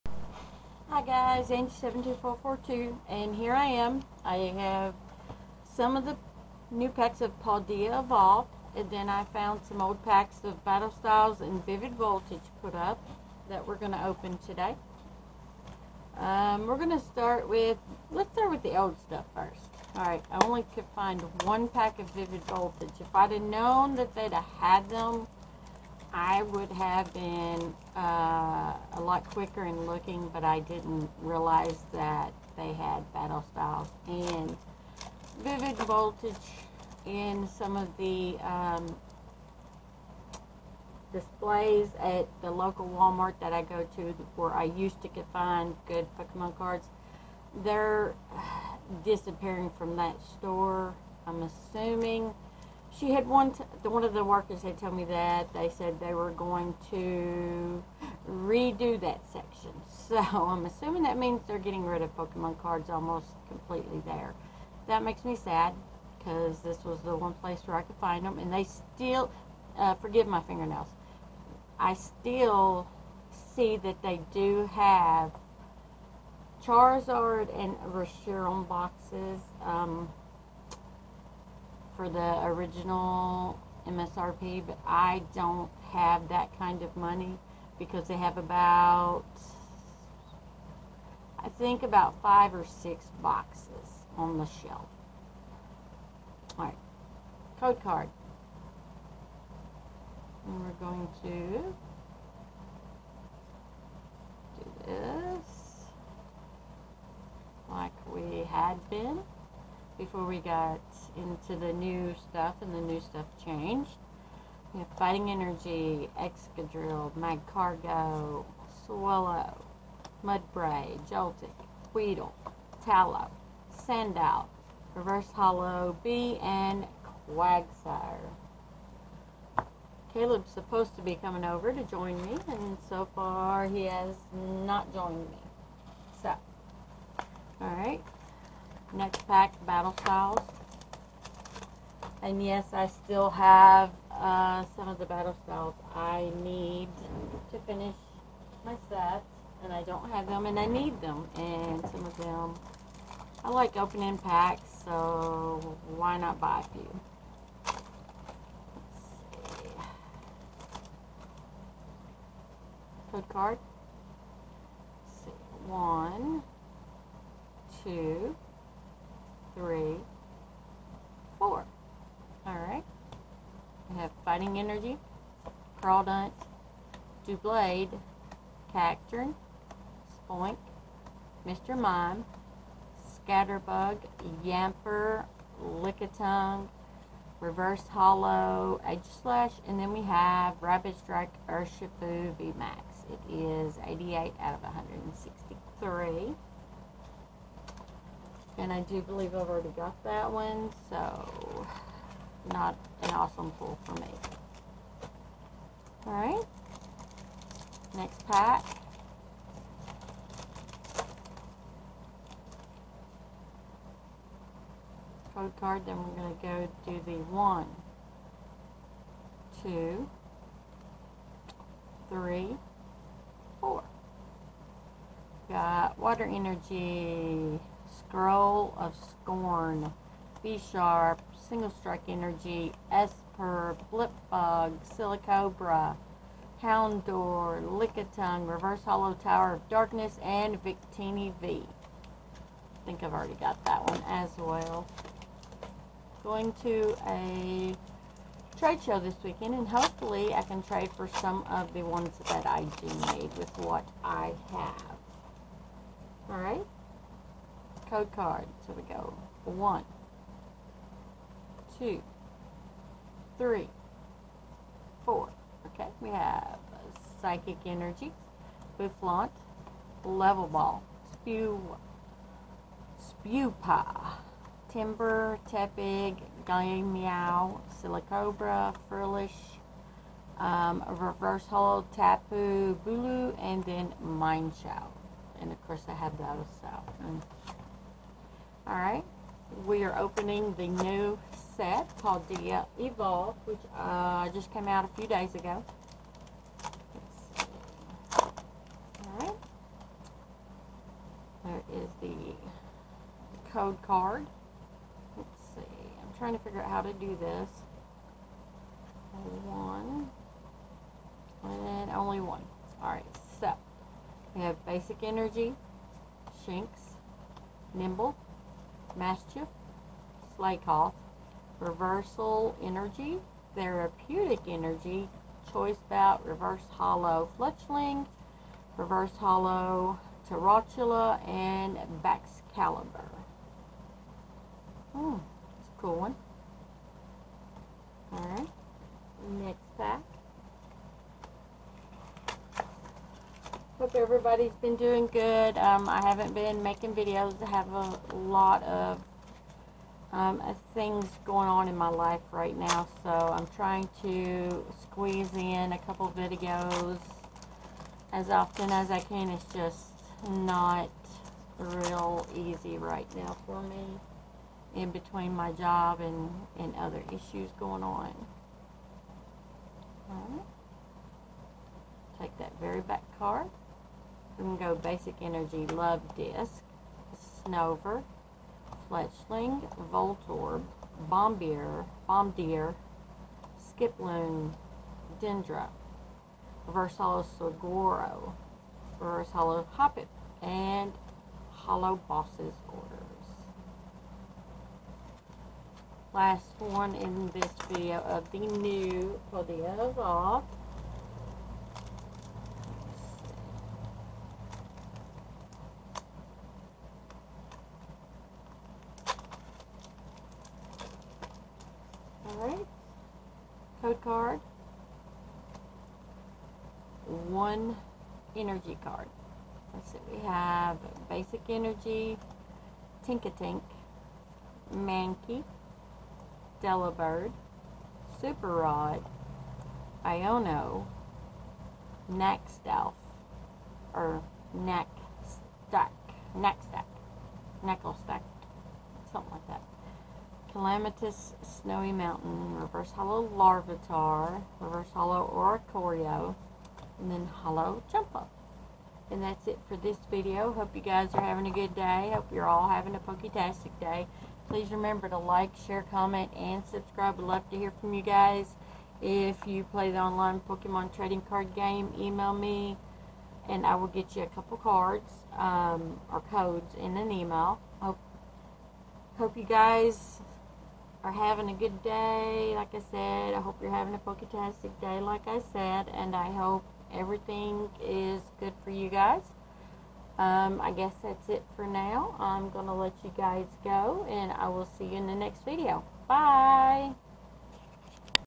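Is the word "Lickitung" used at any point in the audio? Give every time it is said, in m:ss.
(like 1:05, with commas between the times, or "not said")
3:05, 3:57.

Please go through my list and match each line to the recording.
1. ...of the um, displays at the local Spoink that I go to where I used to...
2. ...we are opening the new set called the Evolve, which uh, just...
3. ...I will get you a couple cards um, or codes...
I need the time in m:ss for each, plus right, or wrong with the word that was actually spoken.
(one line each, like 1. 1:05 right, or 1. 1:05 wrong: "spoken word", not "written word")
1. 0:37 wrong: "Walmart", not "Spoink"
2. 4:49 right
3. 7:43 right.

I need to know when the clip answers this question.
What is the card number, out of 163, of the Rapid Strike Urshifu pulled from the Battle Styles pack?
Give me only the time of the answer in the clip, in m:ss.
3:13.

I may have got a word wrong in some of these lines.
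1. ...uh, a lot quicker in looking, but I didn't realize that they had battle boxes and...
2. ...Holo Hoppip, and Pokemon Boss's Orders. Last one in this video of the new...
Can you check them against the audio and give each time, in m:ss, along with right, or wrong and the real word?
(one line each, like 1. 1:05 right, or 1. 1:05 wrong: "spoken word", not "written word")
1. 0:27 wrong: "styles", not "boxes"
2. 6:29 wrong: "Holo", not "Pokemon".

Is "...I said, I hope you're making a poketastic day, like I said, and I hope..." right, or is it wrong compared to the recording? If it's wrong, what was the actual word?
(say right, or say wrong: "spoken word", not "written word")
wrong: "having", not "making".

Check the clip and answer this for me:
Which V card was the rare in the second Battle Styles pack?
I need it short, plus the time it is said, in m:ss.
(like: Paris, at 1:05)
Victini V, at 4:00.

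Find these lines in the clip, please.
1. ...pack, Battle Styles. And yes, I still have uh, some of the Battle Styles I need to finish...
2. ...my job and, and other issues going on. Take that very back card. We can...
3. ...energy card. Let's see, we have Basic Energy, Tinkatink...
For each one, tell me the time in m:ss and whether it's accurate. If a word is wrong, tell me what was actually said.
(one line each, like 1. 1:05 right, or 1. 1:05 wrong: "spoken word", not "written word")
1. 2:19 right
2. 6:05 right
3. 6:58 right.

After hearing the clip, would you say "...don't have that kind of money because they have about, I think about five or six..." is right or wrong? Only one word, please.
right.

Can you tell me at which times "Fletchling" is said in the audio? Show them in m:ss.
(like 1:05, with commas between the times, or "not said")
5:27, 6:18.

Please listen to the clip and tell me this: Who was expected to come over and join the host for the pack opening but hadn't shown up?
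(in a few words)
Kaleb.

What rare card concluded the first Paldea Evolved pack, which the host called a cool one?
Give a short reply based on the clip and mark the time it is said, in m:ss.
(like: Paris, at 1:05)
Baxcalibur, at 5:32.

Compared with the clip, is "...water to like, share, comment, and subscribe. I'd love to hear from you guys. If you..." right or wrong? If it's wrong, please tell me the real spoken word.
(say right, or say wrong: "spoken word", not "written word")
wrong: "remember", not "water".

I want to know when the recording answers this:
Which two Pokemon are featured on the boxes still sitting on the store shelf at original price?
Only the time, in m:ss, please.
1:16.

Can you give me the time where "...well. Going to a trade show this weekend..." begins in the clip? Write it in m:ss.
4:04.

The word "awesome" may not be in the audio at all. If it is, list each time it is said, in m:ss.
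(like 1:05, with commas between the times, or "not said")
3:23.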